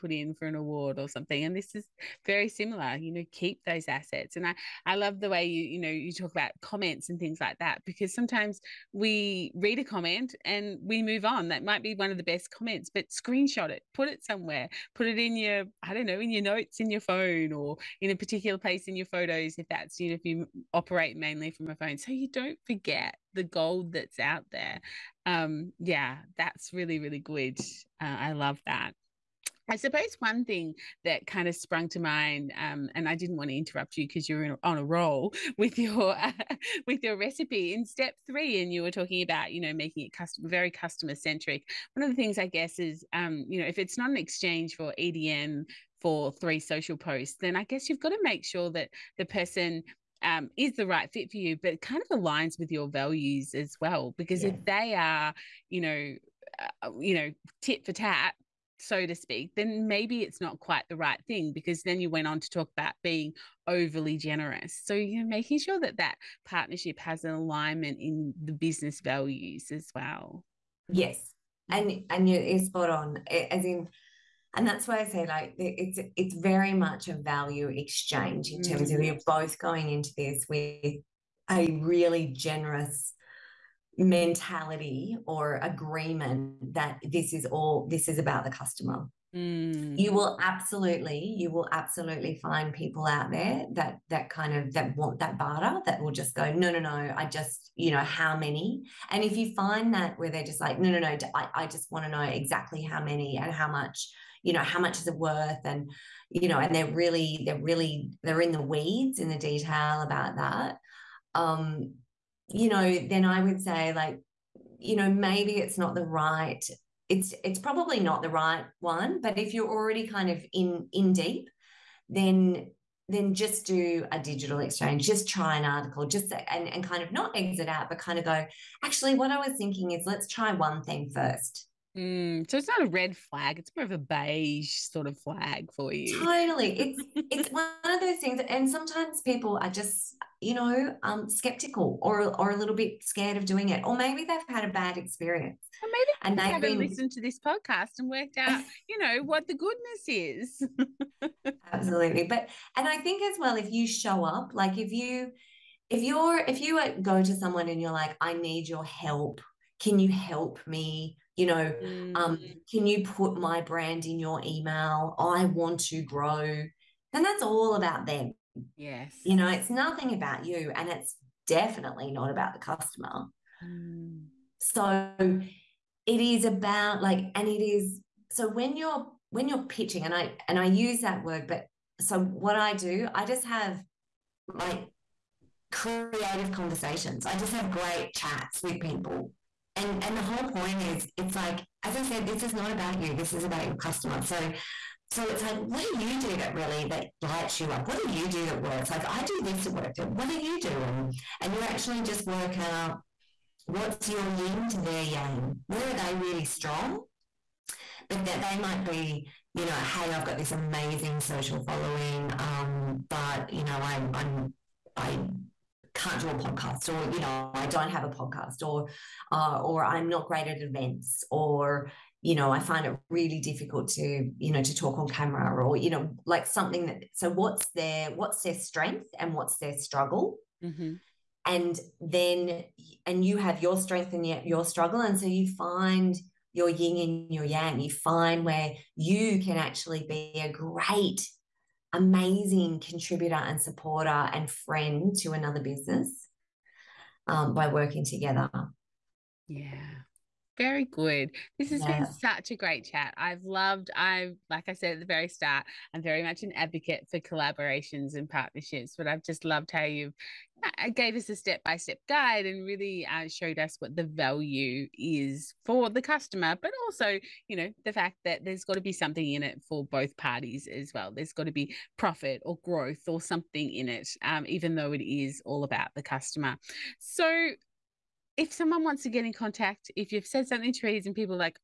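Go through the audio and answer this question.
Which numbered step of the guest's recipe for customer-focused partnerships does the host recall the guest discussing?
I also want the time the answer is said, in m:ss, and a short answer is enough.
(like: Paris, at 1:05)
Step 3, at 0:37.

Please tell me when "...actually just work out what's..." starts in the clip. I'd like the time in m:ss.
3:21.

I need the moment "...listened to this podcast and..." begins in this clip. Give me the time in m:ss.
2:26.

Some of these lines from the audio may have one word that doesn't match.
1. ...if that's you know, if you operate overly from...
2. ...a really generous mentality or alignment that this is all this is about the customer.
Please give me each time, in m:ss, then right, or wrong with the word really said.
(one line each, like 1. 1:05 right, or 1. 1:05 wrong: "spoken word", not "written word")
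1. 0:19 wrong: "mainly", not "overly"
2. 1:21 wrong: "agreement", not "alignment".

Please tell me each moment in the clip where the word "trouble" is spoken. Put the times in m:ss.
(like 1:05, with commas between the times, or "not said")
not said.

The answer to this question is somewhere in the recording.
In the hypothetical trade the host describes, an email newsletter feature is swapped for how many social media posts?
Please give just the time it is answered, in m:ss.
0:46.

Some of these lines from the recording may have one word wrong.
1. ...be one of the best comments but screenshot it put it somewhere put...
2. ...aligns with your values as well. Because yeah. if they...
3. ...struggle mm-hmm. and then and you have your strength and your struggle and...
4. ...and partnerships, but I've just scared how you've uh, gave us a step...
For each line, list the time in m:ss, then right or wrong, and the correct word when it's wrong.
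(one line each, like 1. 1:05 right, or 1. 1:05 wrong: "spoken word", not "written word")
1. 0:11 right
2. 0:52 right
3. 3:49 right
4. 4:18 wrong: "loved", not "scared".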